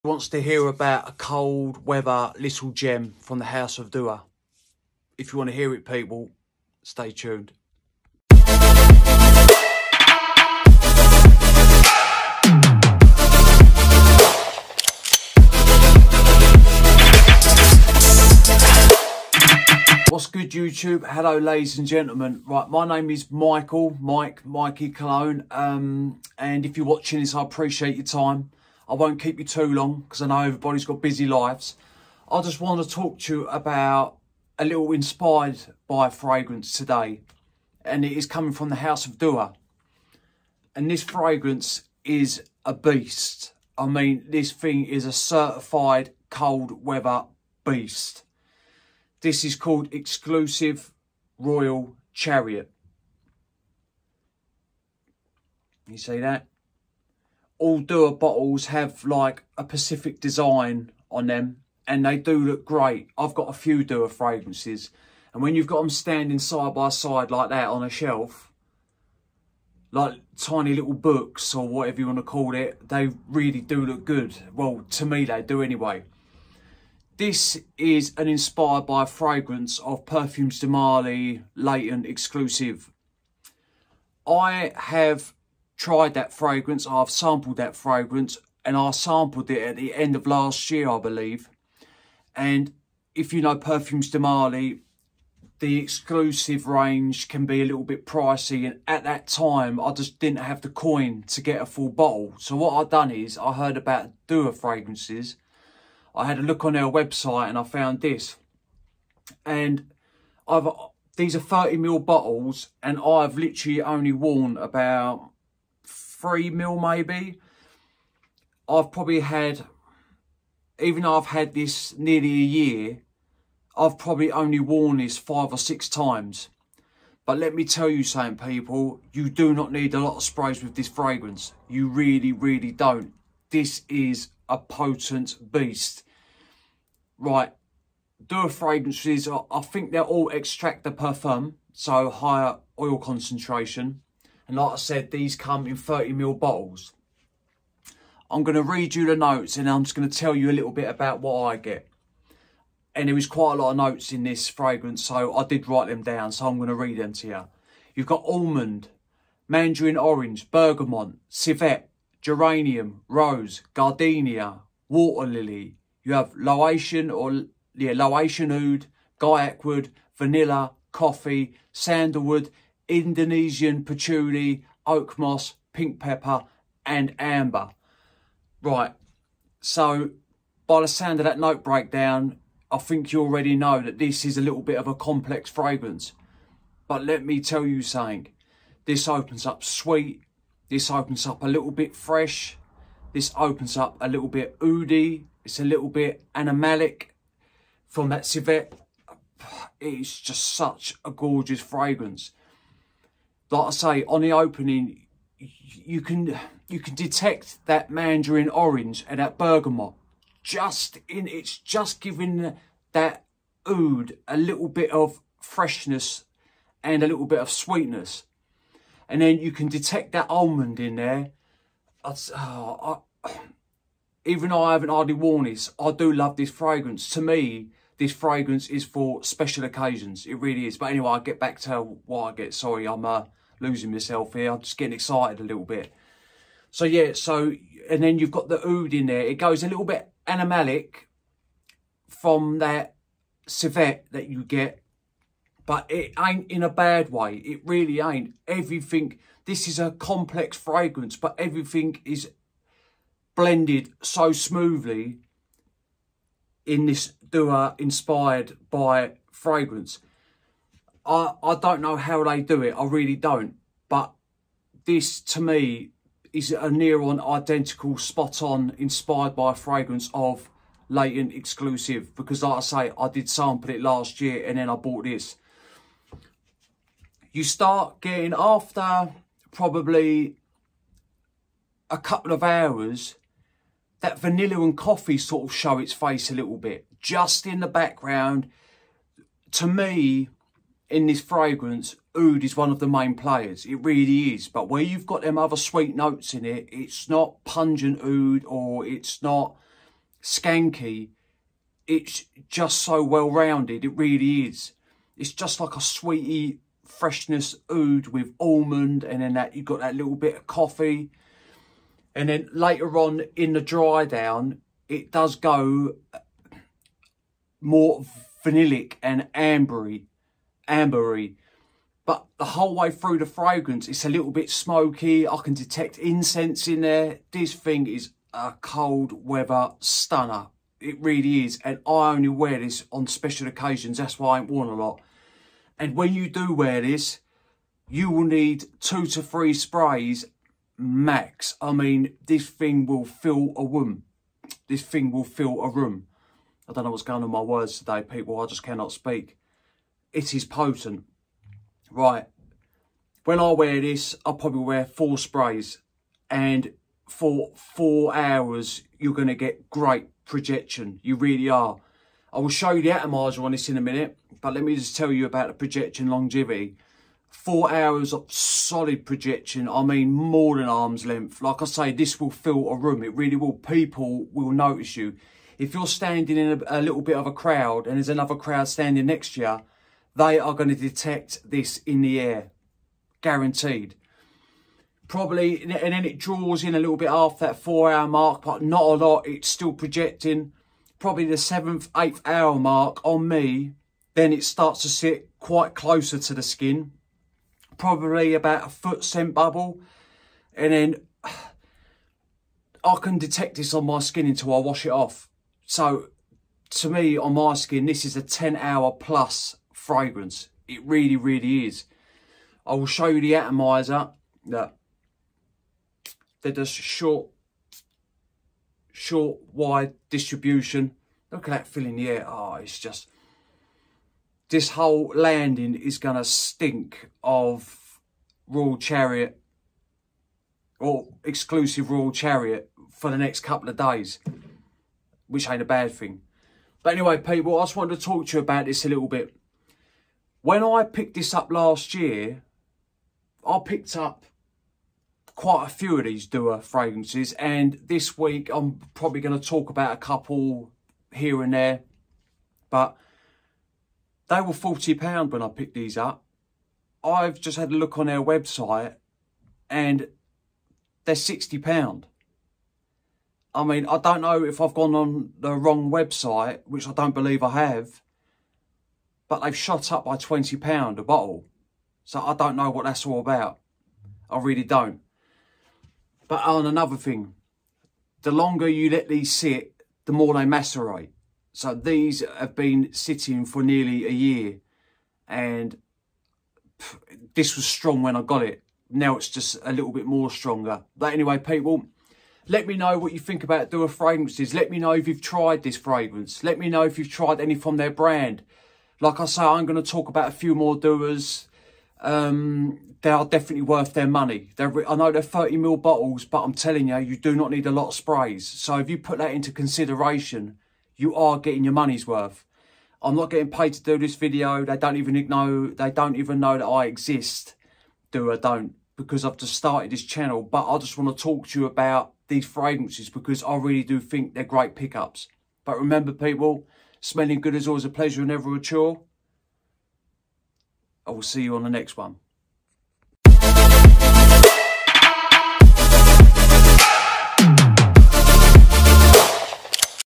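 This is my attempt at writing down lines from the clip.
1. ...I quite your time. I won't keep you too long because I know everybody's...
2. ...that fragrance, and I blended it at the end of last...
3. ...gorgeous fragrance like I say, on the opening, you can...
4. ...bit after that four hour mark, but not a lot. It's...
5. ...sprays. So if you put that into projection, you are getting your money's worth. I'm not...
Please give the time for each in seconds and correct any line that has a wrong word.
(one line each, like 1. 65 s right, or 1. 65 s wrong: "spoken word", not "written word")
1. 27 s wrong: "appreciate", not "quite"
2. 87 s wrong: "sampled", not "blended"
3. 201 s right
4. 386 s right
5. 507 s wrong: "consideration", not "projection".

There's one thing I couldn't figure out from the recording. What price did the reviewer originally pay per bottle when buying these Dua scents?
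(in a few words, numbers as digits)
£40.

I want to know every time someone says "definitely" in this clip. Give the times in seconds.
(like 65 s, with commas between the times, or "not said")
503 s.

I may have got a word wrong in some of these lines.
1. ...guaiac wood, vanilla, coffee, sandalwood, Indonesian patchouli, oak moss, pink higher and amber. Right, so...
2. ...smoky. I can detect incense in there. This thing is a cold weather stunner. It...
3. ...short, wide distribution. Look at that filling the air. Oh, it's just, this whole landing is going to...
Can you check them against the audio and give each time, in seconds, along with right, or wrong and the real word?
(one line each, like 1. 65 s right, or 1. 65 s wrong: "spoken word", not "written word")
1. 169 s wrong: "pepper", not "higher"
2. 324 s right
3. 418 s right.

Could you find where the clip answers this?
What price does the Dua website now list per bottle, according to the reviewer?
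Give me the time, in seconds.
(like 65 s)
461 s.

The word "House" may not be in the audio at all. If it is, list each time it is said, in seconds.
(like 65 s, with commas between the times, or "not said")
3 s, 38 s.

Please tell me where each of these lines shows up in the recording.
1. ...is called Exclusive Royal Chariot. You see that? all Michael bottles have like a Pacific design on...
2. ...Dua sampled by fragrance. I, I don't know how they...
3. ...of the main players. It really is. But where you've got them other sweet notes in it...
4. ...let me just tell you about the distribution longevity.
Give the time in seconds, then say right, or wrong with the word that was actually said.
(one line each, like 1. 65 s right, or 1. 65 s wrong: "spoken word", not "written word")
1. 49 s wrong: "Dua", not "Michael"
2. 257 s wrong: "inspired", not "sampled"
3. 292 s right
4. 364 s wrong: "projection", not "distribution".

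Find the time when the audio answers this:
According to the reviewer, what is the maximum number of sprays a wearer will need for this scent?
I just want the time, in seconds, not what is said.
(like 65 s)
338 s.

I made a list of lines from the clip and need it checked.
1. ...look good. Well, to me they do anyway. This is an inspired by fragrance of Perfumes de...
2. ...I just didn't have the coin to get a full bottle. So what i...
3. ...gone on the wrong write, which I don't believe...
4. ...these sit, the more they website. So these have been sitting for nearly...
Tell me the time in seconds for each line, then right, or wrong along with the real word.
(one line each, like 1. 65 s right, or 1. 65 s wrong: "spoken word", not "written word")
1. 73 s right
2. 99 s right
3. 464 s wrong: "website", not "write"
4. 479 s wrong: "macerate", not "website".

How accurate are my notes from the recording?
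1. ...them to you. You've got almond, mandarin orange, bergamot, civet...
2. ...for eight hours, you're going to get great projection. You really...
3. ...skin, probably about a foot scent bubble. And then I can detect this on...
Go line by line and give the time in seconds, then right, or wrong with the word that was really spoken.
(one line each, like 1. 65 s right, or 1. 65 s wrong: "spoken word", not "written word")
1. 156 s right
2. 357 s wrong: "four", not "eight"
3. 396 s right.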